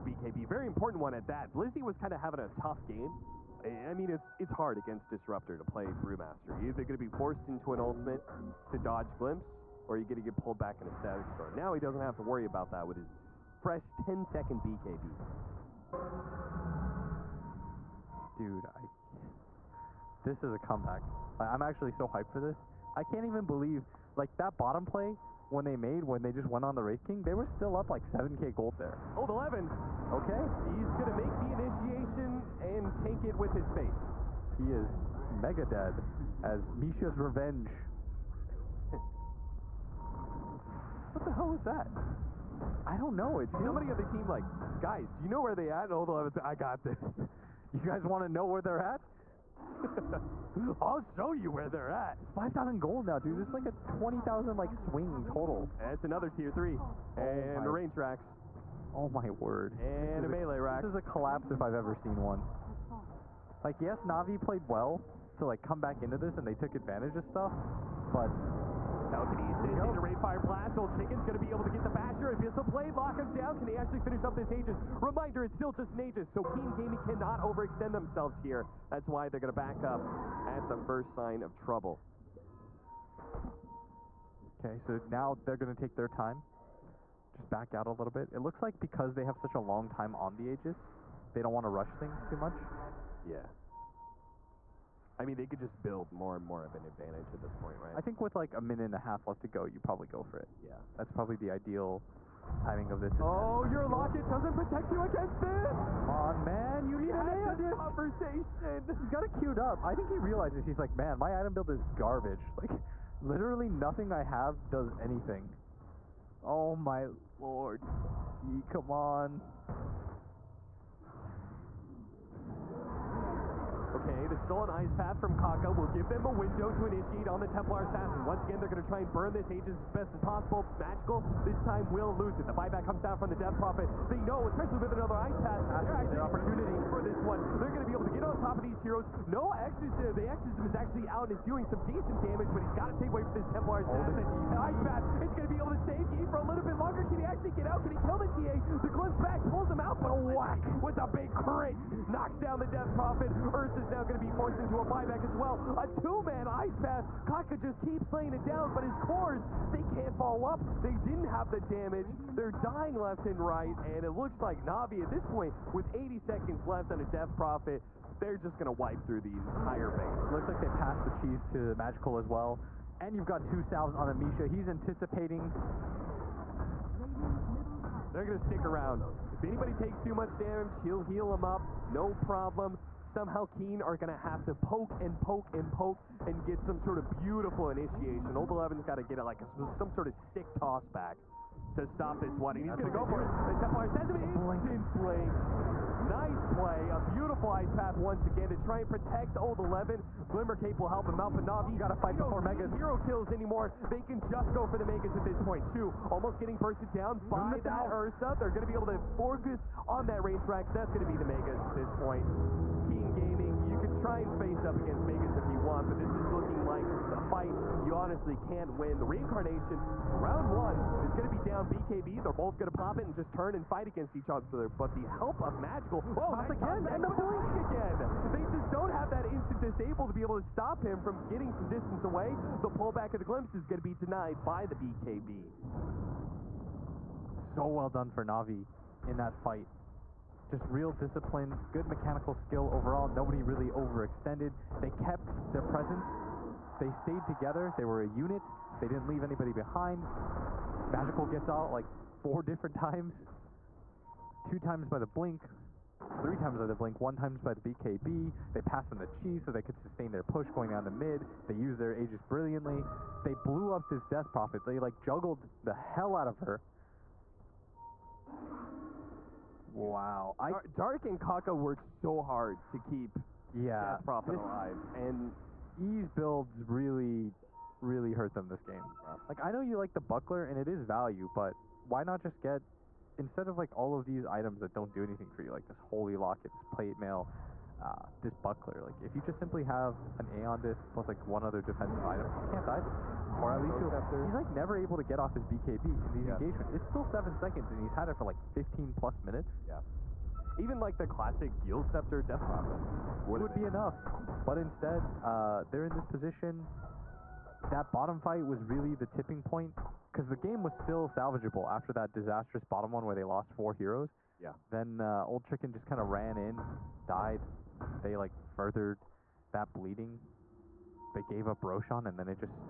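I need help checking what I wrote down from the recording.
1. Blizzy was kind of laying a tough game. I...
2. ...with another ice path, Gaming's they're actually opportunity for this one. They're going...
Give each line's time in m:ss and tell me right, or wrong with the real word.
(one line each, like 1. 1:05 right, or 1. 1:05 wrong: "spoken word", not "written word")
1. 0:01 wrong: "having", not "laying"
2. 2:14 wrong: "That", not "Gaming".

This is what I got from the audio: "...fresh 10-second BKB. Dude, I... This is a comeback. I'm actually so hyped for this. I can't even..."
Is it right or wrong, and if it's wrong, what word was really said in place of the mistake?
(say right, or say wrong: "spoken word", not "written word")
right.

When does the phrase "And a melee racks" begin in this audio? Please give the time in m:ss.
0:59.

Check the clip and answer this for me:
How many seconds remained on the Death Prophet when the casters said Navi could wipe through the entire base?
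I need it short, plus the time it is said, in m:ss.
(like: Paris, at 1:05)
80, at 2:45.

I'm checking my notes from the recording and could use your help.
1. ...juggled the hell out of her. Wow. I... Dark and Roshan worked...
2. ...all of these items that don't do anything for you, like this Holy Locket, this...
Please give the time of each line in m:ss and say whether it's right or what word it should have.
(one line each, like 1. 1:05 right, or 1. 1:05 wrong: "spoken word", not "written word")
1. 4:24 wrong: "Kaka", not "Roshan"
2. 4:43 right.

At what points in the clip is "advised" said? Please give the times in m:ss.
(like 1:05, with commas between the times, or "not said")
not said.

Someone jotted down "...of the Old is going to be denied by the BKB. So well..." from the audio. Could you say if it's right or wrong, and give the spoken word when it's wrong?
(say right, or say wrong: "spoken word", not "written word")
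wrong: "Glimpse", not "Old".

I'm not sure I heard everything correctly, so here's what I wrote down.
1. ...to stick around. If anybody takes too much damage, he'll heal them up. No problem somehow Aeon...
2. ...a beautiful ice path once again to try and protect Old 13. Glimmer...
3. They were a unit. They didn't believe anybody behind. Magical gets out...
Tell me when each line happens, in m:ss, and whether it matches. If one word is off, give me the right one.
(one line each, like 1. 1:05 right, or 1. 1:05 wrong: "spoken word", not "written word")
1. 2:58 wrong: "Keen", not "Aeon"
2. 3:16 wrong: "11", not "13"
3. 4:07 wrong: "leave", not "believe".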